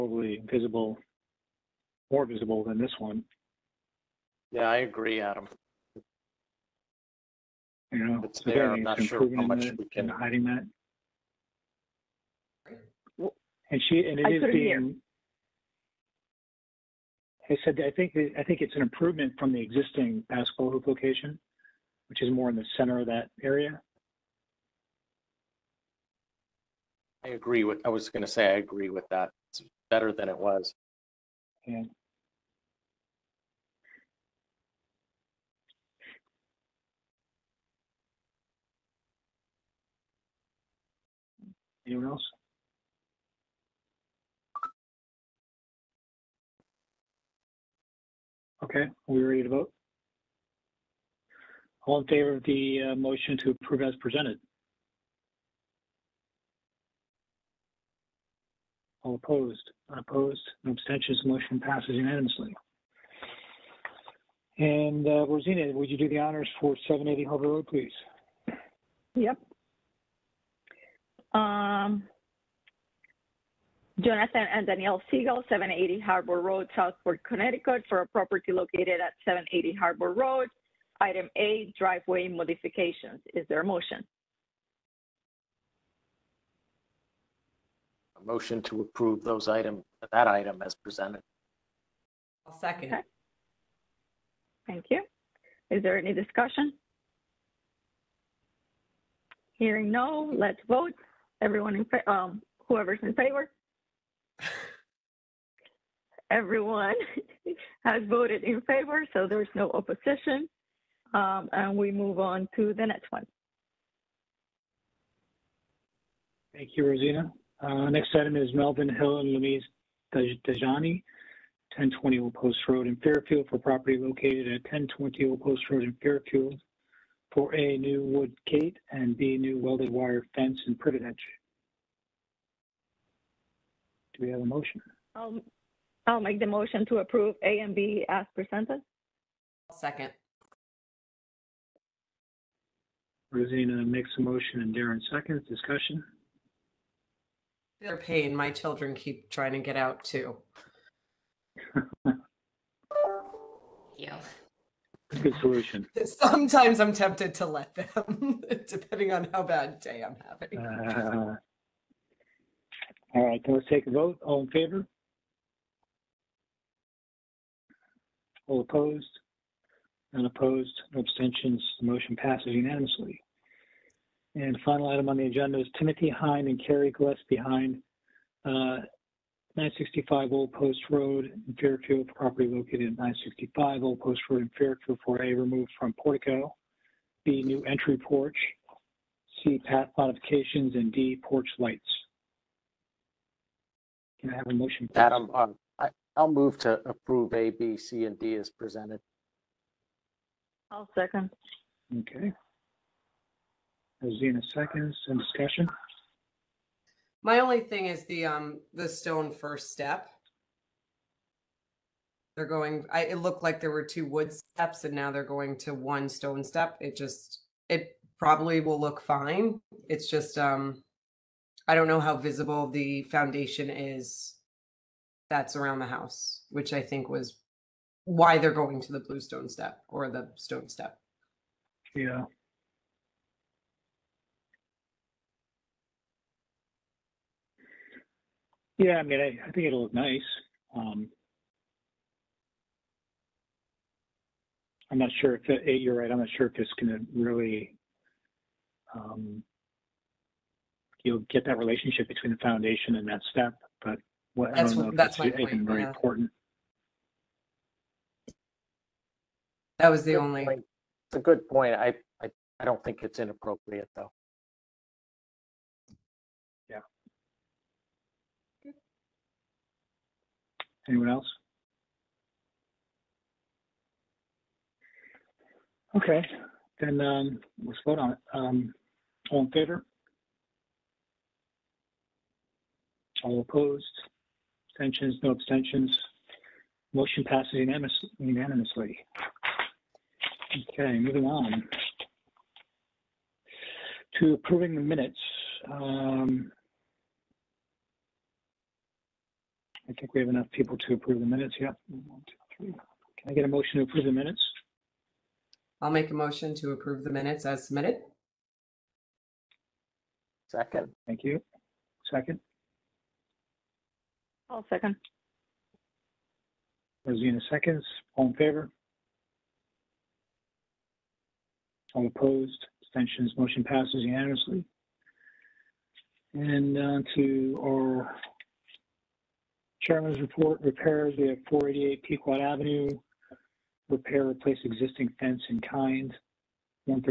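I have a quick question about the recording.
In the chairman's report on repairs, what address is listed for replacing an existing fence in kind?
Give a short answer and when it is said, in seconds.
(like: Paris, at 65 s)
488 Pequot Avenue, at 331 s.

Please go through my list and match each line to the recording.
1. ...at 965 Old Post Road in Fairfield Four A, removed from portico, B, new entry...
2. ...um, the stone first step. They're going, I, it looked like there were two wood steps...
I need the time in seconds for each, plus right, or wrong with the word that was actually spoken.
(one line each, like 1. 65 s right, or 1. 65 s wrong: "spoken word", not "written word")
1. 182 s right
2. 208 s right.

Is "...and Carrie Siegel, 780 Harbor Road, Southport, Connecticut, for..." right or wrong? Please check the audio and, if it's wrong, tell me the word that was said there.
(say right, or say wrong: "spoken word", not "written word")
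wrong: "Danielle", not "Carrie".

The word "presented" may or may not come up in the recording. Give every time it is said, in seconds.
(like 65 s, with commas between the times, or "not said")
53 s, 90 s, 138 s, 198 s.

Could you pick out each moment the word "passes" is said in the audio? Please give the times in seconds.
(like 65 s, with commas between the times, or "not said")
61 s, 172 s, 287 s, 323 s.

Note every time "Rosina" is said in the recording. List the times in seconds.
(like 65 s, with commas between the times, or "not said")
65 s, 116 s, 143 s, 204 s, 317 s.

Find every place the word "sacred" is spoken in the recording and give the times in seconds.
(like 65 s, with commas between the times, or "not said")
not said.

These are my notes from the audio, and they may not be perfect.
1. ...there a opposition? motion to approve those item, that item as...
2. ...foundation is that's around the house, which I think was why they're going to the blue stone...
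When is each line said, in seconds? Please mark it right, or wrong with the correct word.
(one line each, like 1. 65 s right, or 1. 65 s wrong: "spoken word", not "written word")
1. 83 s wrong: "motion", not "opposition"
2. 223 s right.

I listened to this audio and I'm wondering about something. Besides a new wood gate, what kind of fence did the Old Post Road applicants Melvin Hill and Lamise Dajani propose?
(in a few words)
Welded wire fence.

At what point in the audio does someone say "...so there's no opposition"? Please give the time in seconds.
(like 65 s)
109 s.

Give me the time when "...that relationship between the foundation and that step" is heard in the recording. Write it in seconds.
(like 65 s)
251 s.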